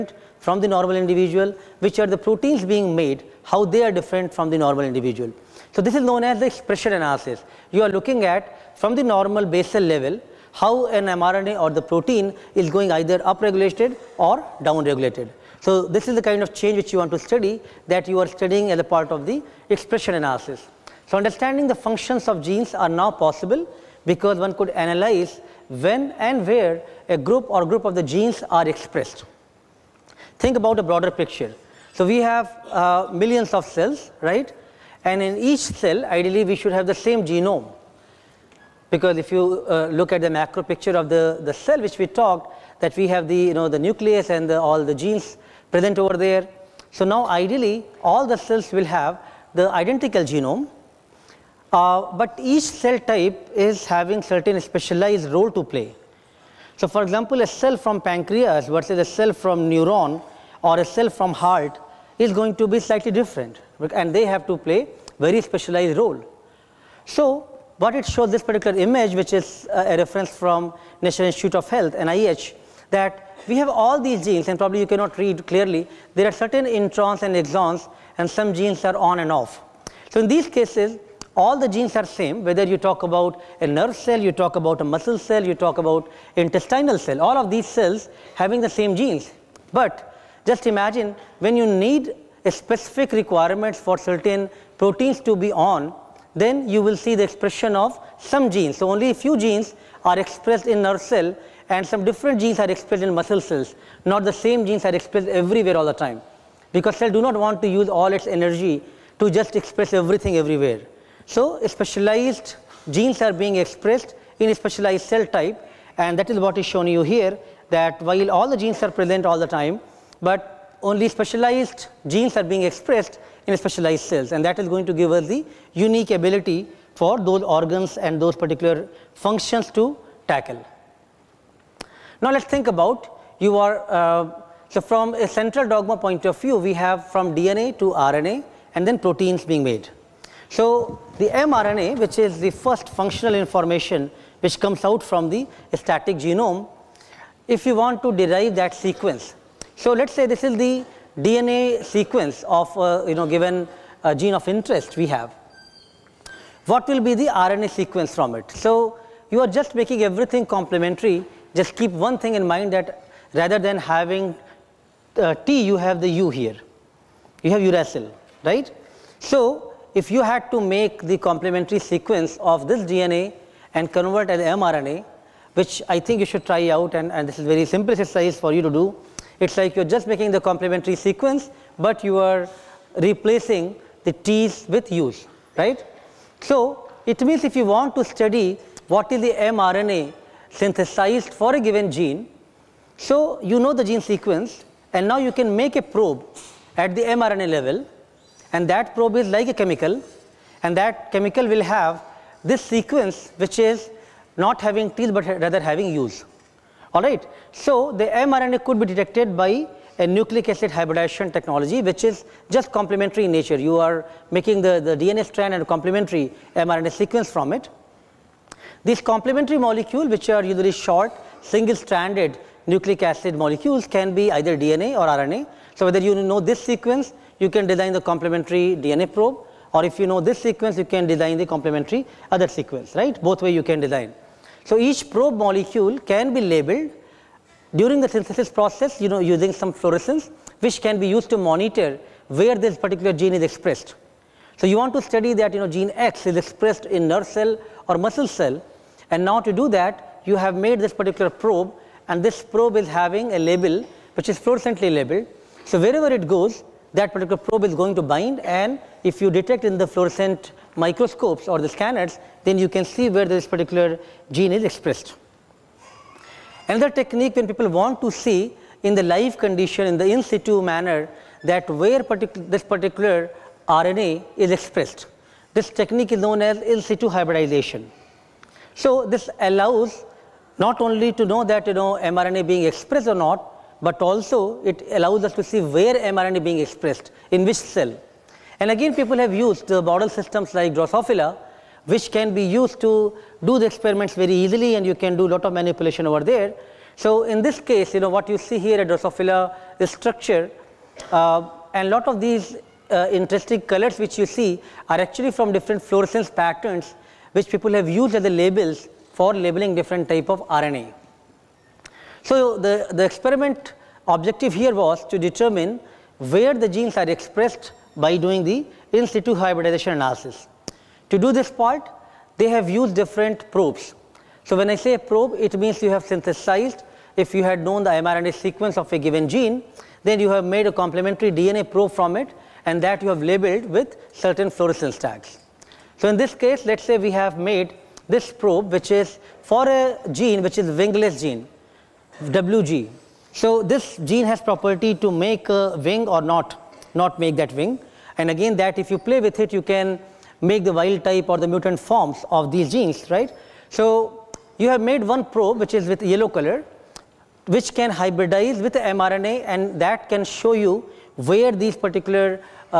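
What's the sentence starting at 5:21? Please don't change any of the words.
To do this part, they have used different probes.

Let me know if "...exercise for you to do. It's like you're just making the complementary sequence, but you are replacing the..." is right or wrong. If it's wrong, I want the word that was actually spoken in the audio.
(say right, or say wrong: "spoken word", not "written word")
right.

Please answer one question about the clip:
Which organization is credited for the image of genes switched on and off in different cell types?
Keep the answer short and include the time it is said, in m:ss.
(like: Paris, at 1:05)
National Institute of Health, at 1:10.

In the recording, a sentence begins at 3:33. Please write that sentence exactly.
You are making the, the DNA strand and a complementary mRNA sequence from it.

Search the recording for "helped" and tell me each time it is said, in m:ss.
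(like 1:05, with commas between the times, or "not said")
not said.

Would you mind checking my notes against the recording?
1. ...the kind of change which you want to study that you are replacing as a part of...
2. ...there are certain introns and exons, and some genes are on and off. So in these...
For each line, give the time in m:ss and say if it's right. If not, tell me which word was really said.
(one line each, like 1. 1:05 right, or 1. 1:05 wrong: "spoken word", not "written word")
1. 0:16 wrong: "studying", not "replacing"
2. 1:16 right.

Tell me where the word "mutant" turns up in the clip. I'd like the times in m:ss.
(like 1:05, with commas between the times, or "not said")
5:51.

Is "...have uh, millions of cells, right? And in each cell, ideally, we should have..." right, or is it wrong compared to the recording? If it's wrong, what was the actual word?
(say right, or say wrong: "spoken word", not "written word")
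right.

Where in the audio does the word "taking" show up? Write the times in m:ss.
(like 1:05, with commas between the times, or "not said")
not said.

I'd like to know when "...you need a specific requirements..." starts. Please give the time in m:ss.
1:31.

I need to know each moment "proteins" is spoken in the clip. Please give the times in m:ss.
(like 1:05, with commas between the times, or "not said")
0:02, 0:11, 1:34, 2:18.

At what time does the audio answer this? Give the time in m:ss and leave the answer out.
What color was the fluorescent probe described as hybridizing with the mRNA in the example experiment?
5:56.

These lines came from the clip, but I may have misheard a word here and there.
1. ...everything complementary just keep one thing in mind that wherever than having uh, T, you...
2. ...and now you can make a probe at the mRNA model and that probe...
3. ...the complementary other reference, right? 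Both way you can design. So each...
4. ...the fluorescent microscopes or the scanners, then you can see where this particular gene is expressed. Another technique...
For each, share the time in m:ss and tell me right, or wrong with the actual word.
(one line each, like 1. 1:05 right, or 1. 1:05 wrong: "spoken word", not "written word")
1. 2:40 wrong: "rather", not "wherever"
2. 3:14 wrong: "level", not "model"
3. 3:51 wrong: "sequence", not "reference"
4. 4:19 right.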